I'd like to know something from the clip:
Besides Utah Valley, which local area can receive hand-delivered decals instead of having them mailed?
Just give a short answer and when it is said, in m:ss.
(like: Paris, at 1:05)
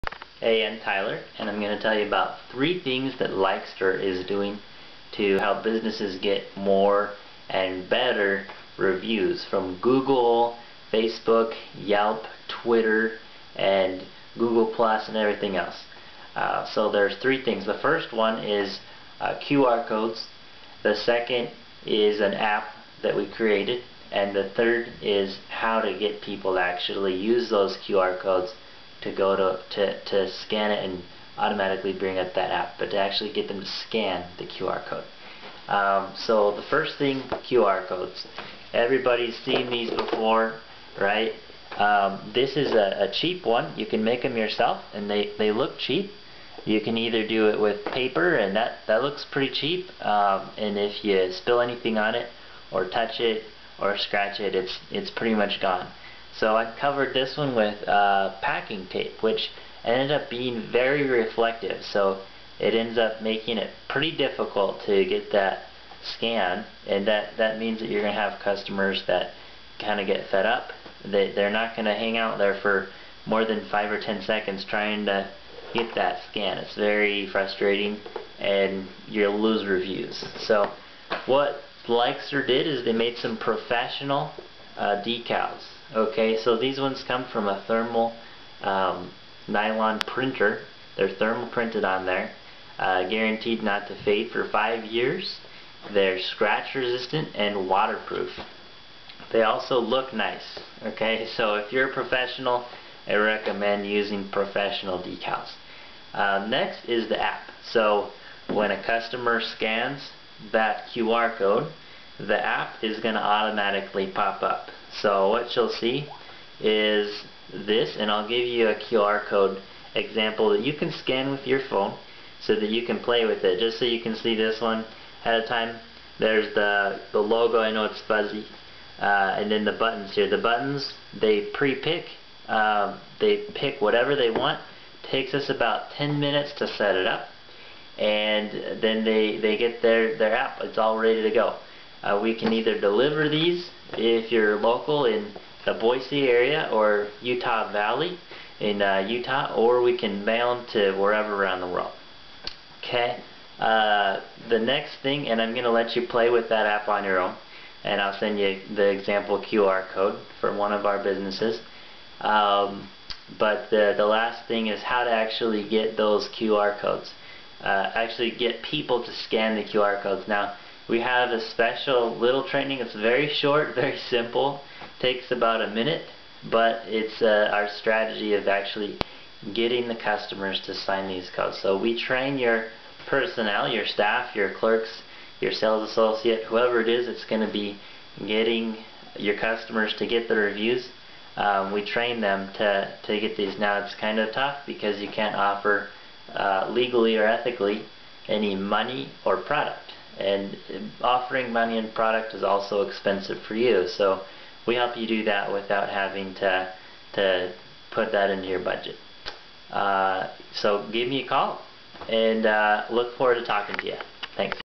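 Boise, at 2:25.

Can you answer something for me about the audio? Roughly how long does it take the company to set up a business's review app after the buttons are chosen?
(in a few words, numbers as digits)
10 minutes.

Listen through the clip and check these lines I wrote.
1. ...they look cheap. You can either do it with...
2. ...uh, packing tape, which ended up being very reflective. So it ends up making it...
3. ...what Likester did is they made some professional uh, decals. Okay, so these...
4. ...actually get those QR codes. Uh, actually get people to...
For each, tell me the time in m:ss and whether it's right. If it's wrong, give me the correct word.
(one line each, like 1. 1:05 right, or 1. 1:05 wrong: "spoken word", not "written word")
1. 0:45 right
2. 0:57 right
3. 1:21 right
4. 2:45 right.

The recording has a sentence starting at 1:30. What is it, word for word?
They're thermal printed on there, uh, guaranteed not to fade for five years.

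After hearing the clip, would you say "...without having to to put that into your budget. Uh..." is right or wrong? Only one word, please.
right.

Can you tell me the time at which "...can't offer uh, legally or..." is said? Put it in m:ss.
3:15.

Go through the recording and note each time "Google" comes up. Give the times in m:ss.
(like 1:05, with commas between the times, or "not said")
0:09, 0:14.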